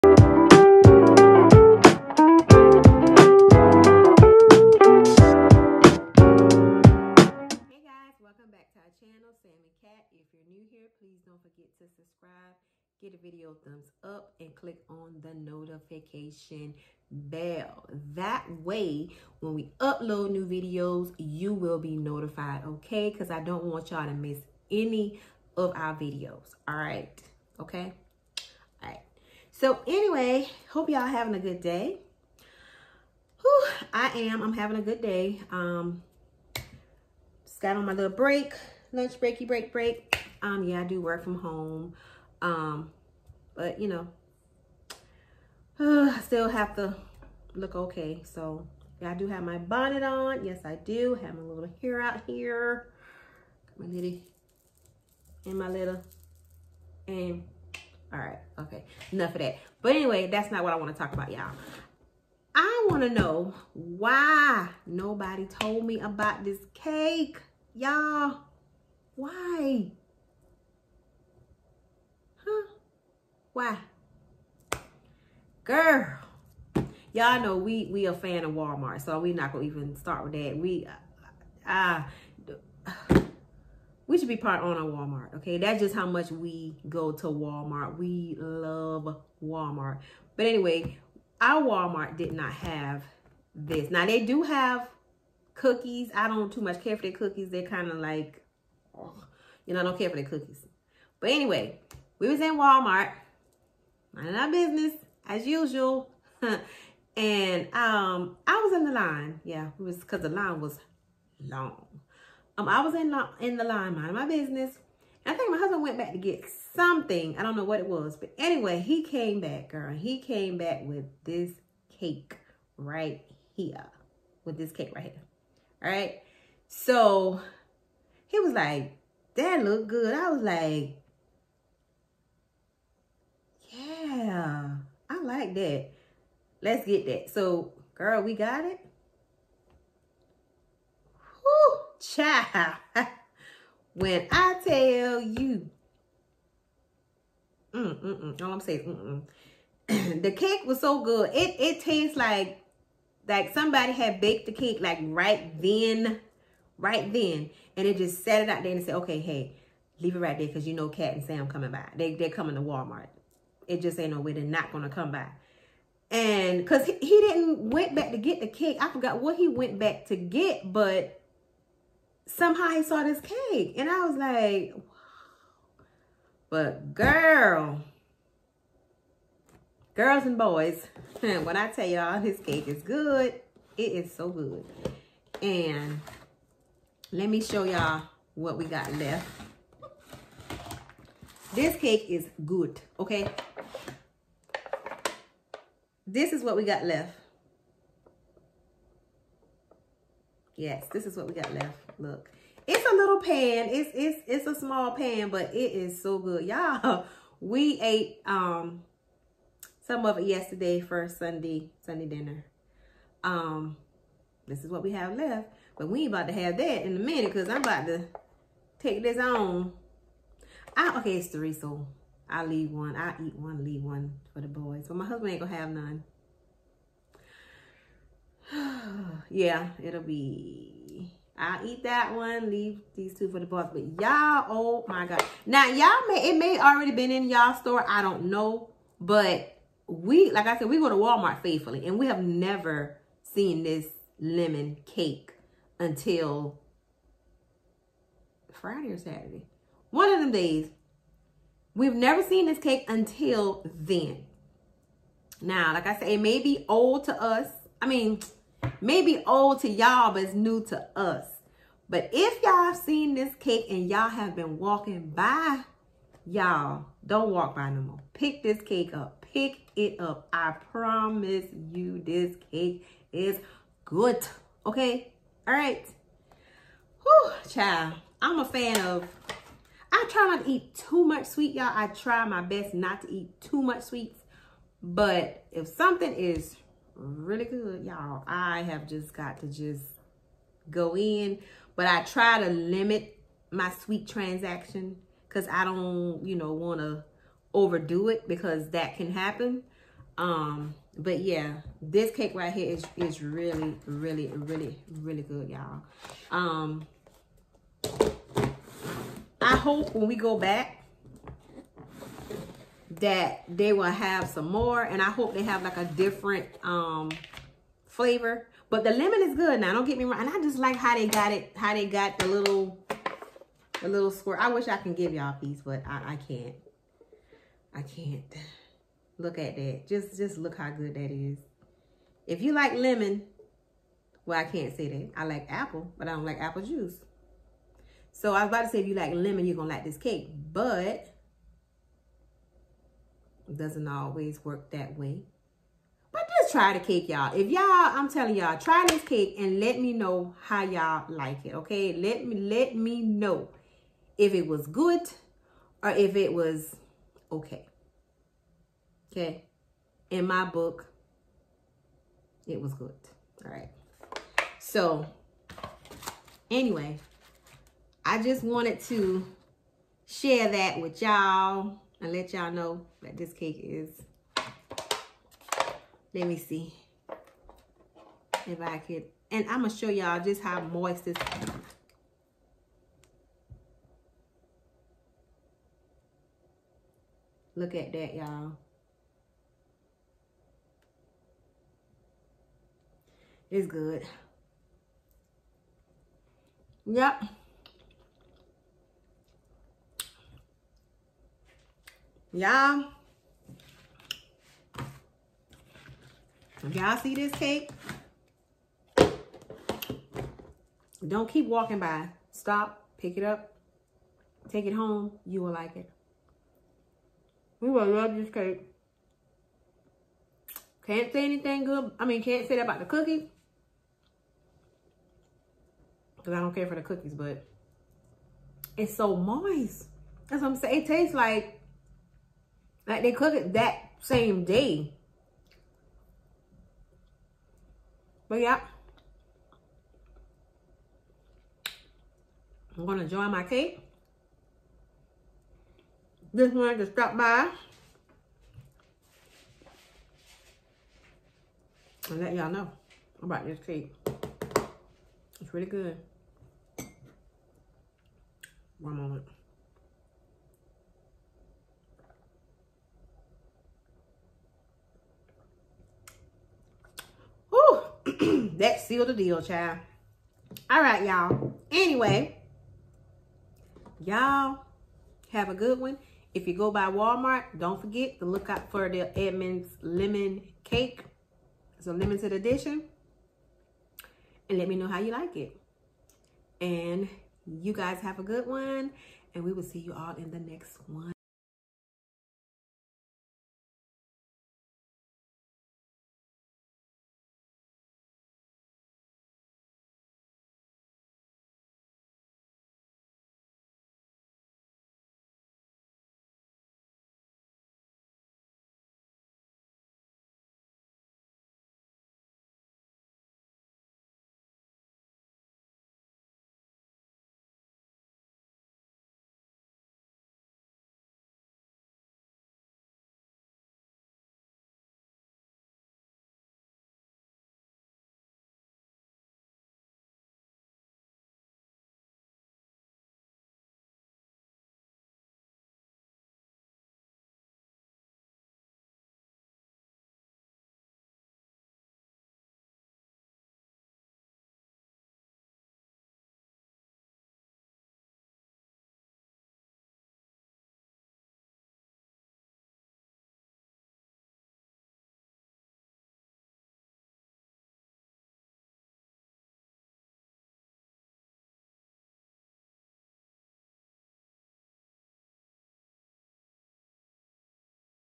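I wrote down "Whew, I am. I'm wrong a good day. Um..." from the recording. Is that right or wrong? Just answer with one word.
wrong.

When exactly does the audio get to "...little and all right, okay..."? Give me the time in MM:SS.
00:55.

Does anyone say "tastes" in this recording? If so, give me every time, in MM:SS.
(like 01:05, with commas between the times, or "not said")
02:31, 07:10.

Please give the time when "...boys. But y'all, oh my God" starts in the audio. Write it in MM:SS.
03:53.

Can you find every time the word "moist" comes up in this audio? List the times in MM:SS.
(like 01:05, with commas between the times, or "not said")
06:20, 07:09.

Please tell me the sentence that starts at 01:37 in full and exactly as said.
They're kind of like, oh, you know, I don't care for their cookies.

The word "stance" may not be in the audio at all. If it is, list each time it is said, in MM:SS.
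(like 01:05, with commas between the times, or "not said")
not said.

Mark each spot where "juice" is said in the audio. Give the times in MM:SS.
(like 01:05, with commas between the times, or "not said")
05:36.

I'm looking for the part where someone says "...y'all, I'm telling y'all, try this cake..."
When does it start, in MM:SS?
05:47.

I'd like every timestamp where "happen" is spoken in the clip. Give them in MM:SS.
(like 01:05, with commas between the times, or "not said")
04:59.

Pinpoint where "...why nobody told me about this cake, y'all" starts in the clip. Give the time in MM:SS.
01:03.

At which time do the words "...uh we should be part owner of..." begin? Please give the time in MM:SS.
01:22.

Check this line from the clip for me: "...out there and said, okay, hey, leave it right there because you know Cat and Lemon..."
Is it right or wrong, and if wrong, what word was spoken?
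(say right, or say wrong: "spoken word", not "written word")
wrong: "Sam", not "Lemon".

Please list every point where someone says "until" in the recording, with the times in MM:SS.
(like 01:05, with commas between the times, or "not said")
04:05, 04:12.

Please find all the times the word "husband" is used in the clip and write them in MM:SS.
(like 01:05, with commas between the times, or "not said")
01:55, 03:45.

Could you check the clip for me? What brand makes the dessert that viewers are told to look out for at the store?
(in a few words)
Entenmann's.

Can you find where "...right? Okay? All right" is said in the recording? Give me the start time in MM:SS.
00:26.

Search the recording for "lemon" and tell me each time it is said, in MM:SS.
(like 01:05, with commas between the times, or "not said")
04:04, 05:18, 05:32, 05:39, 07:59.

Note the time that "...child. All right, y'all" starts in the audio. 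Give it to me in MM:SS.
07:49.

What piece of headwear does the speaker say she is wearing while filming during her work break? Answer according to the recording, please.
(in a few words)
Bonnet.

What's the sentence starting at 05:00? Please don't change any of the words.
Um, but yeah, this cake right here is, is really, really, really, really good, y'all.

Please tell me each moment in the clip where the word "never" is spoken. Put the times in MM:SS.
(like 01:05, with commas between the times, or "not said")
04:02, 04:11.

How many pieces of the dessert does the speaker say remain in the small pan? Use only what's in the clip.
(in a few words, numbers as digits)
3.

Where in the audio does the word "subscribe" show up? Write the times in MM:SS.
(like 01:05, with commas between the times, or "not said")
00:11.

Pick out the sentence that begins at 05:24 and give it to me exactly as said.
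I wish I can give y'all these, but I, I can't.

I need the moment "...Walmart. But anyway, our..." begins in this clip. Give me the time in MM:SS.
01:29.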